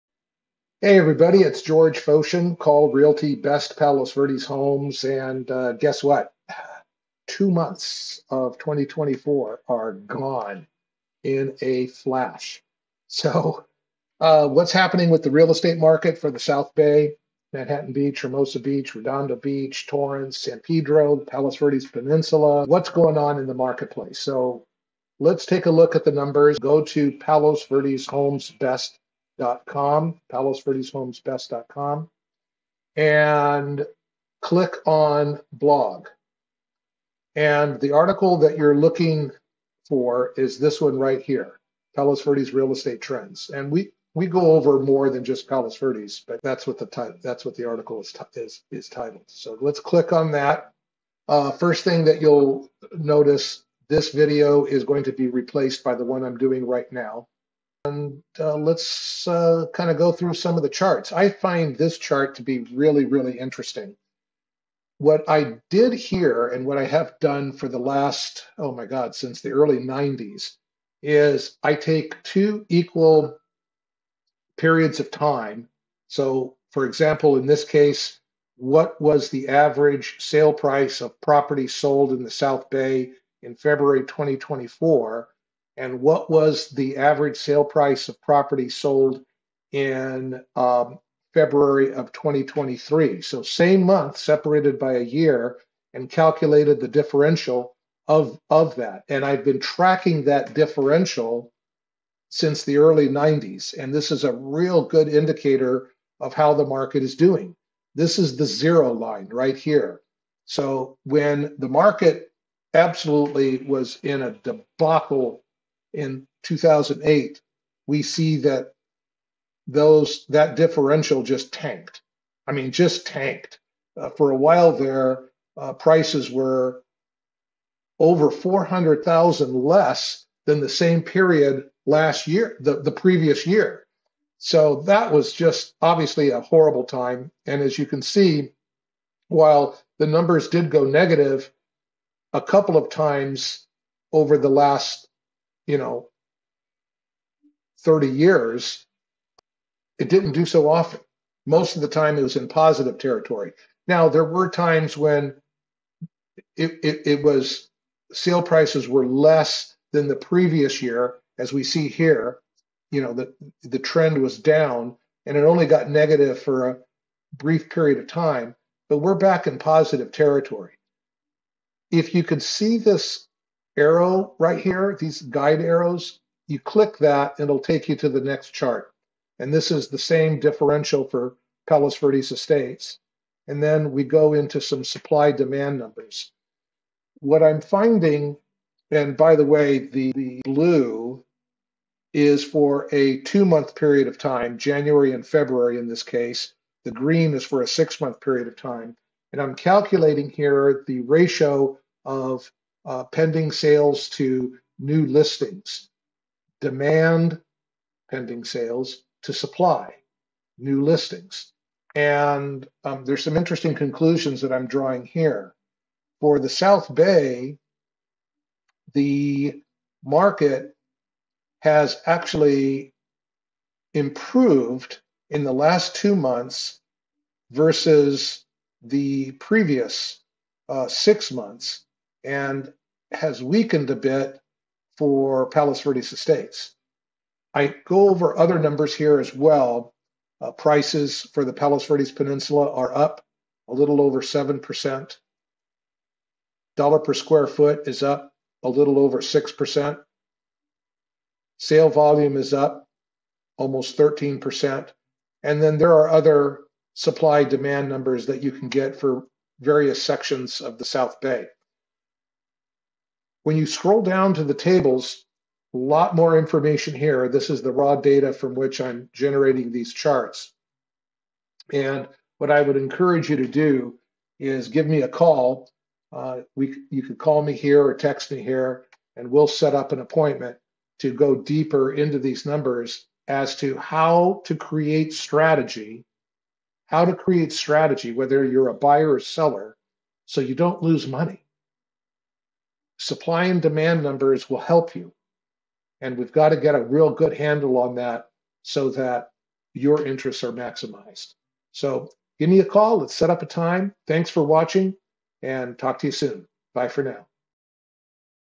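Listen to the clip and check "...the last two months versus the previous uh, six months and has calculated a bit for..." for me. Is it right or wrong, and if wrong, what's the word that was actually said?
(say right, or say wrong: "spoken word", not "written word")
wrong: "weakened", not "calculated".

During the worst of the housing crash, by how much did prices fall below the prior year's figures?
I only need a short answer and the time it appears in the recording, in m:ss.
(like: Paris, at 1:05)
400,000, at 2:07.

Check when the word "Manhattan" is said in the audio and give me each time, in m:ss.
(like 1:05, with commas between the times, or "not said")
0:17.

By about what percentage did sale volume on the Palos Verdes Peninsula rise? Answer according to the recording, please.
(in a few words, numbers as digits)
almost 13%.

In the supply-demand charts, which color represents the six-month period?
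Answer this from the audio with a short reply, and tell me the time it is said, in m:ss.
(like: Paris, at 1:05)
green, at 3:16.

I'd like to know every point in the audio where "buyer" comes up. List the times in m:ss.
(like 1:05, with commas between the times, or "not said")
4:48.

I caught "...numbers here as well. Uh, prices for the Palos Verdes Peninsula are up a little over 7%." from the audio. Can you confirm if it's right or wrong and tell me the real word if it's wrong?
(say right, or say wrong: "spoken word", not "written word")
right.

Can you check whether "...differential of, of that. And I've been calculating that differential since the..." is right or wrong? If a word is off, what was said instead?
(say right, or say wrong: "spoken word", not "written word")
wrong: "tracking", not "calculating".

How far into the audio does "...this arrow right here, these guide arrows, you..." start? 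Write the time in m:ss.
2:52.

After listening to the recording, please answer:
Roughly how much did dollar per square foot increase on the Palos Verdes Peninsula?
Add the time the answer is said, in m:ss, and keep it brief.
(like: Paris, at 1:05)
a little over 6%, at 4:08.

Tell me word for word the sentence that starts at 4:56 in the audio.
And we've got to get a real good handle on that so that your interests are maximized.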